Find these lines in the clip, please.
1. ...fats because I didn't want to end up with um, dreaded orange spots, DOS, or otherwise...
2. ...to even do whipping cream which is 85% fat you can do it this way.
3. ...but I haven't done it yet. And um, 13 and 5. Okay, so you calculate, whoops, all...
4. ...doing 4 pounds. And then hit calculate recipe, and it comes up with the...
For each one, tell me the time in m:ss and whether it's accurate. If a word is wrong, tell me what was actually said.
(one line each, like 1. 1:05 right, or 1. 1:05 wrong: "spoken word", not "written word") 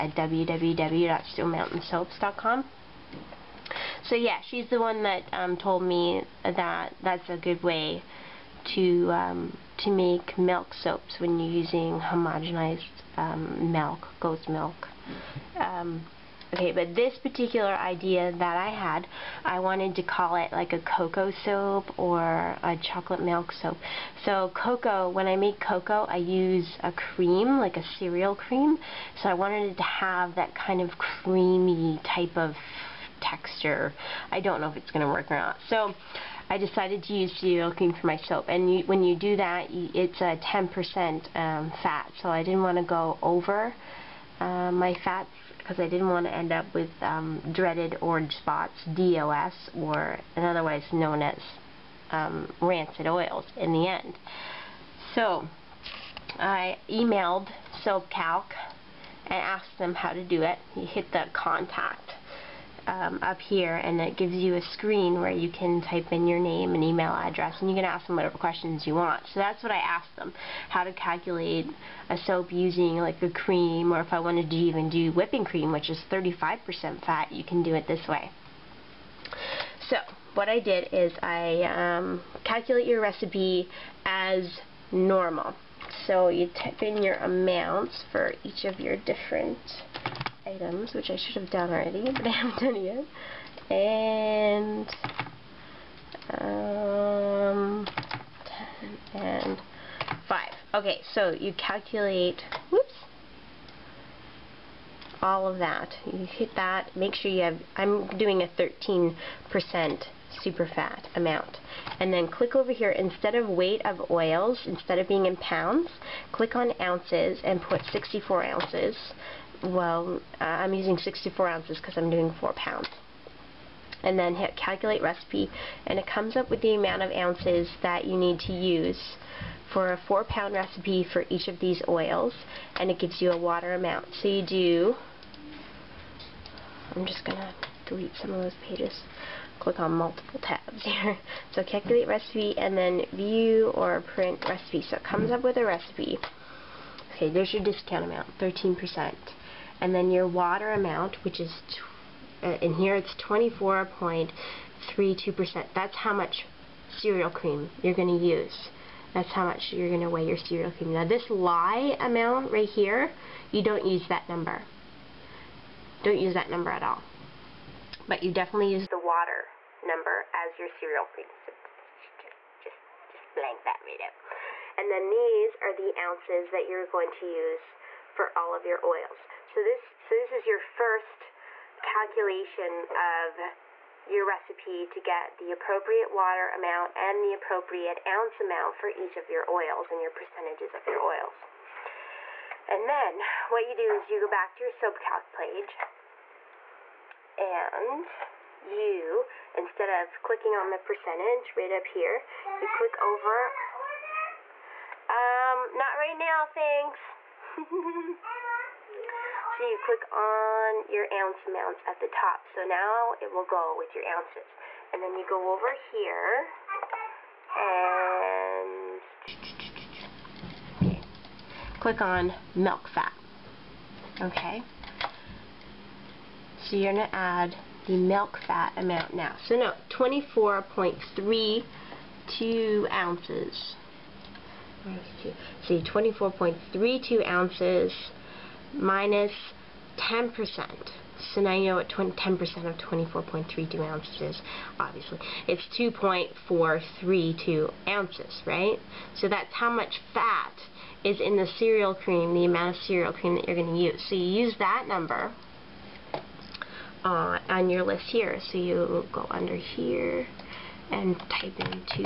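1. 0:45 right
2. 1:14 wrong: "35", not "85"
3. 1:32 wrong: "10", not "13"
4. 2:02 right.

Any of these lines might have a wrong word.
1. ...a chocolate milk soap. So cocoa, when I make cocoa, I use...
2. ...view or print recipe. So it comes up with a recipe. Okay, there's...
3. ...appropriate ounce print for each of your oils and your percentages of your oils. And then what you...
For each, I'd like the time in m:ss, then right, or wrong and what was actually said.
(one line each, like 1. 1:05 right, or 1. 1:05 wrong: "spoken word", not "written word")
1. 0:22 right
2. 2:23 right
3. 3:07 wrong: "amount", not "print".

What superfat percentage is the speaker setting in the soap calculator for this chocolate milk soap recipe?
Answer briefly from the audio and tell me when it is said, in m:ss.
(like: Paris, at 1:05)
13%, at 1:48.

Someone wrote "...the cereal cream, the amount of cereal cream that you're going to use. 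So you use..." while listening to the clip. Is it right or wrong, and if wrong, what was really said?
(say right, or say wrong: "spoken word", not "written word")
right.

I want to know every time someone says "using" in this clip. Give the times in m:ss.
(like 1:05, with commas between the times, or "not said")
0:11, 1:12, 2:00.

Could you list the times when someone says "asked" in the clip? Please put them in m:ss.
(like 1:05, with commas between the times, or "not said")
0:59, 1:09.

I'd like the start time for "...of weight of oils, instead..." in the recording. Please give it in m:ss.
1:53.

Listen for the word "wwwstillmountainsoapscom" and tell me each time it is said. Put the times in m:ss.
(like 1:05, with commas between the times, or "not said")
0:00.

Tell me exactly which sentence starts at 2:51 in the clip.
So just, blank that, right out.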